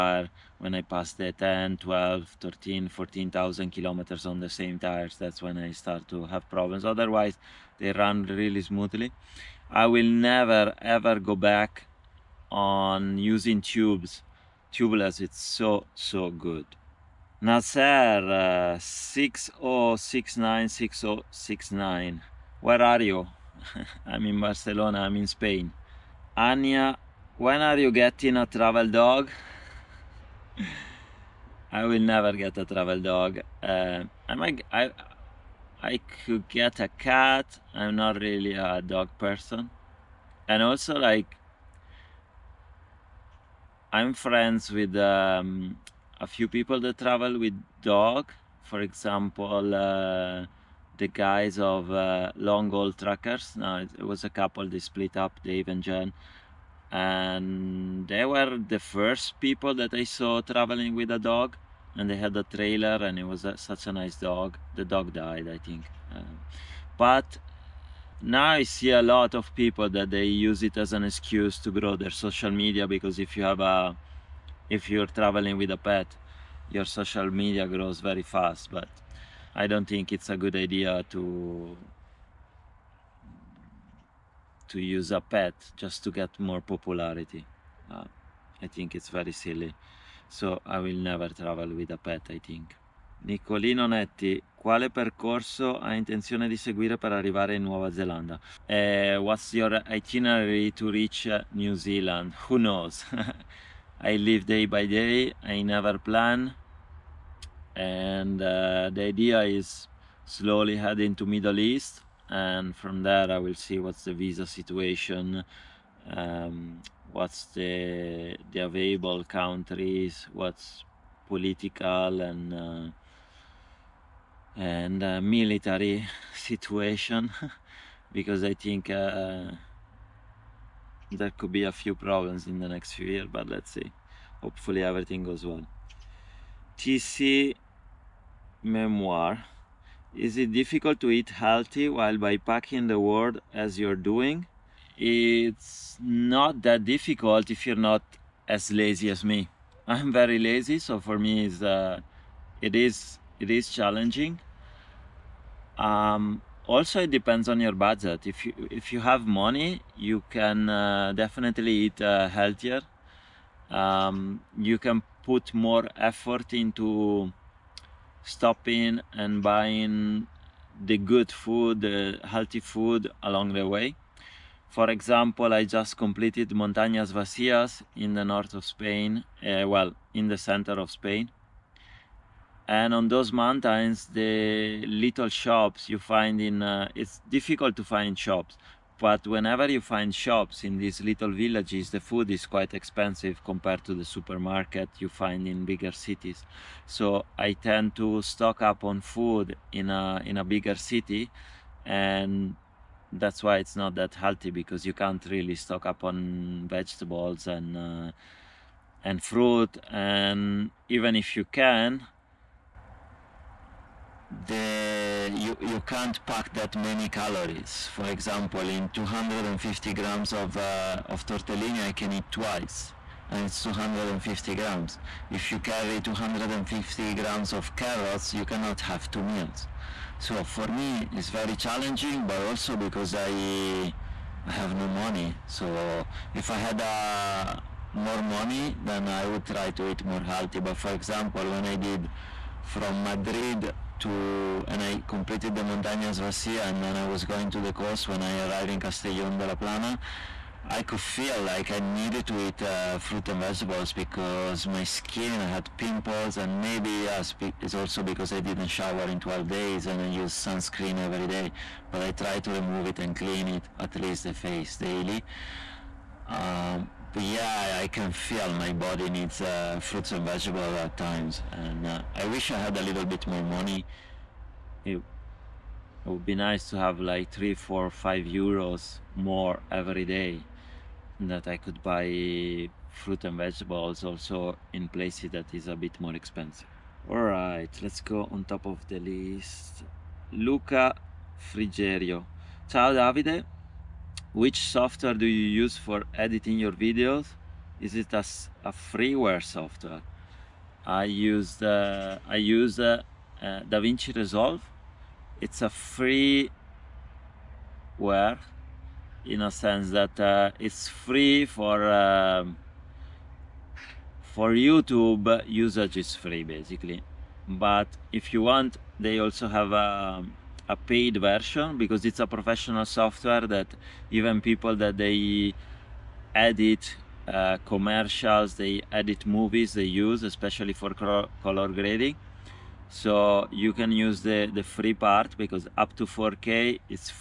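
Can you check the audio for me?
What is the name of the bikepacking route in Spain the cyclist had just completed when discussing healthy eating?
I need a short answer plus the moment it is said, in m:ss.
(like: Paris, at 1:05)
Montañas Vacías, at 2:56.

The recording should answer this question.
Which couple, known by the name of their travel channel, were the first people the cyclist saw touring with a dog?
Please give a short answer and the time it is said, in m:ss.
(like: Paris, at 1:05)
Long Haul Trekkers, at 0:52.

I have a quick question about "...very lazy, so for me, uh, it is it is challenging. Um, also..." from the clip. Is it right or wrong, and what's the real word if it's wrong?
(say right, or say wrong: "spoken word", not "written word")
right.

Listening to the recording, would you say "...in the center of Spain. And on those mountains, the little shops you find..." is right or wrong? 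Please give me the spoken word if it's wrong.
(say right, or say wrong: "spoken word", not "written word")
right.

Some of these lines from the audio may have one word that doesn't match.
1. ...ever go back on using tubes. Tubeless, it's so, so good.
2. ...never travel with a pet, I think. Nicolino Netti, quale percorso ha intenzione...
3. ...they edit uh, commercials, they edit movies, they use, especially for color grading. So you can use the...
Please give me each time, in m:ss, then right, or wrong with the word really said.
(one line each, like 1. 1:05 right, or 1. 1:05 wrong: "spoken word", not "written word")
1. 0:10 right
2. 1:31 right
3. 5:24 right.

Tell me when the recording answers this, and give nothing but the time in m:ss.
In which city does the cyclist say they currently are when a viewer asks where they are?
0:24.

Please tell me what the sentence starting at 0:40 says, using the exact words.
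And also like, I'm friends with um, a few people that travel with dog.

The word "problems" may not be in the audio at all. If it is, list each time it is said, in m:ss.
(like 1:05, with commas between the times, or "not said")
0:06, 2:11.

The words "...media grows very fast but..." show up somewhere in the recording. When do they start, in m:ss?
1:17.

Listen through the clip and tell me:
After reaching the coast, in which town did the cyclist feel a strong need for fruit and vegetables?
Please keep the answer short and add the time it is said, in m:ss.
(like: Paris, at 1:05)
Castellón de la Plana, at 4:08.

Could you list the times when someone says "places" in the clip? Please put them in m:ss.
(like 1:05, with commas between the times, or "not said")
4:44.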